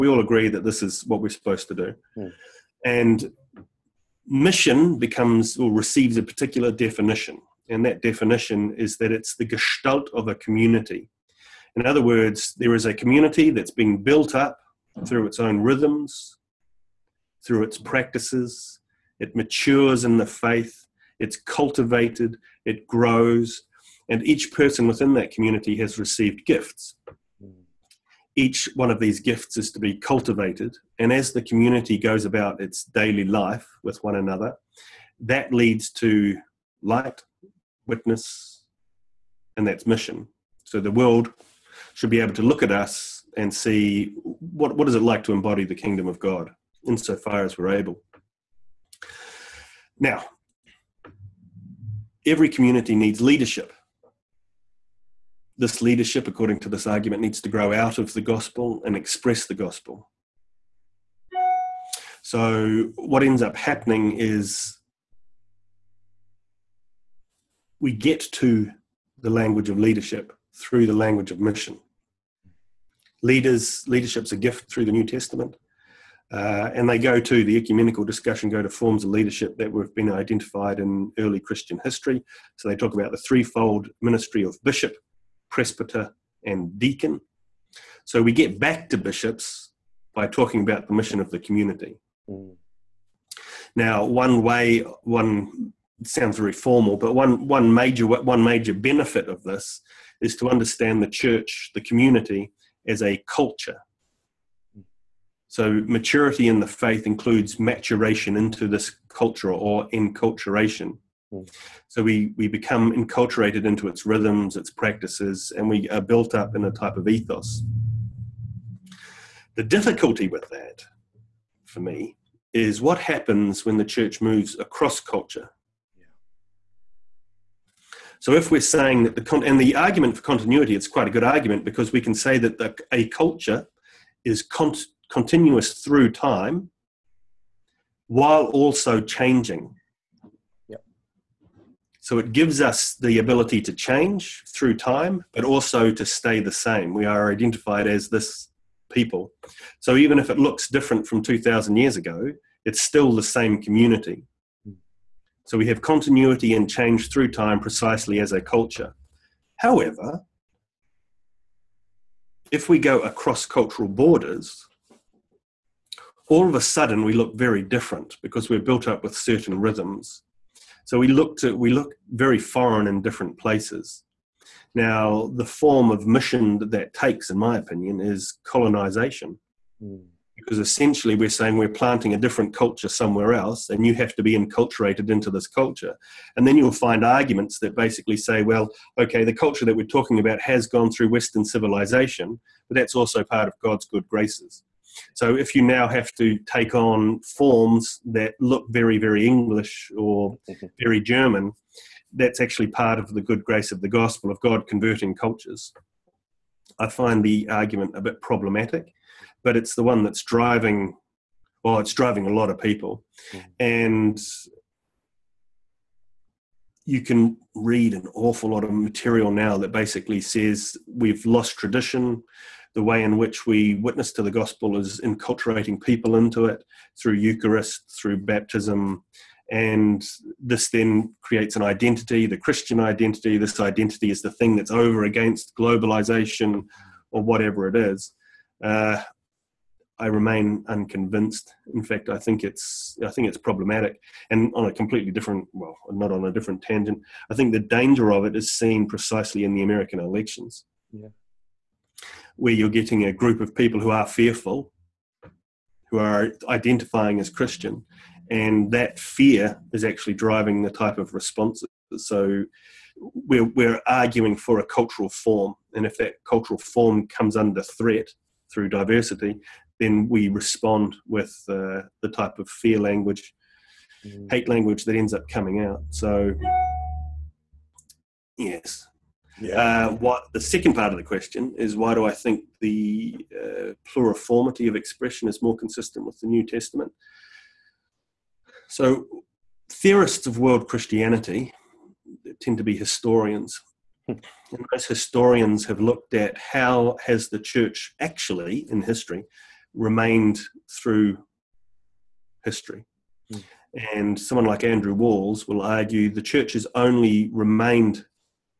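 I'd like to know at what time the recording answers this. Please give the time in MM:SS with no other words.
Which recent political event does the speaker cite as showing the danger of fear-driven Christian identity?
04:09.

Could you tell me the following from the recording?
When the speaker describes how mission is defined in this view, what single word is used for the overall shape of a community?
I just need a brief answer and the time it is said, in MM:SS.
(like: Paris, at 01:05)
gestalt, at 00:09.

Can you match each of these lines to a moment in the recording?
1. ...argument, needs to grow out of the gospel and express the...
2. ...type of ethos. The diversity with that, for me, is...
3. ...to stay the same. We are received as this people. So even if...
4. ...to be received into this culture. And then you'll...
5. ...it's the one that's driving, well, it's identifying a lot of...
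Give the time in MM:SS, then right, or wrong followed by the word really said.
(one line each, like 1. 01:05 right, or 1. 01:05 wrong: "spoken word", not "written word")
1. 00:56 right
2. 01:56 wrong: "difficulty", not "diversity"
3. 02:25 wrong: "identified", not "received"
4. 03:04 wrong: "enculturated", not "received"
5. 03:29 wrong: "driving", not "identifying".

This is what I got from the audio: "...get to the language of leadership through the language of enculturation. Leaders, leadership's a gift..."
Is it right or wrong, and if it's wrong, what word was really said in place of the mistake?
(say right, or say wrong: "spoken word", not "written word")
wrong: "mission", not "enculturation".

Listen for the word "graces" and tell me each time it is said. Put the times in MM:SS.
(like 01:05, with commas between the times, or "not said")
03:14, 03:23.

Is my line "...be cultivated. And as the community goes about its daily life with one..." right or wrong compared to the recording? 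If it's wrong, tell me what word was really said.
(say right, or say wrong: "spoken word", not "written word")
right.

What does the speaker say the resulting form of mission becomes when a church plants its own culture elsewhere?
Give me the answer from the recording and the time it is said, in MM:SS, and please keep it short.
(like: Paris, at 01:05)
colonization, at 02:58.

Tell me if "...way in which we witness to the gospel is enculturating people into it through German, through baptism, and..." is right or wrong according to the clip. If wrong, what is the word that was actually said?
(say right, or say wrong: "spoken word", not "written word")
wrong: "Eucharist", not "German".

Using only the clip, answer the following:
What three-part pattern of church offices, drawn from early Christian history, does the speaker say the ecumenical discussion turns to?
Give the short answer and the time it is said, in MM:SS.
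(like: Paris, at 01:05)
threefold ministry, at 01:23.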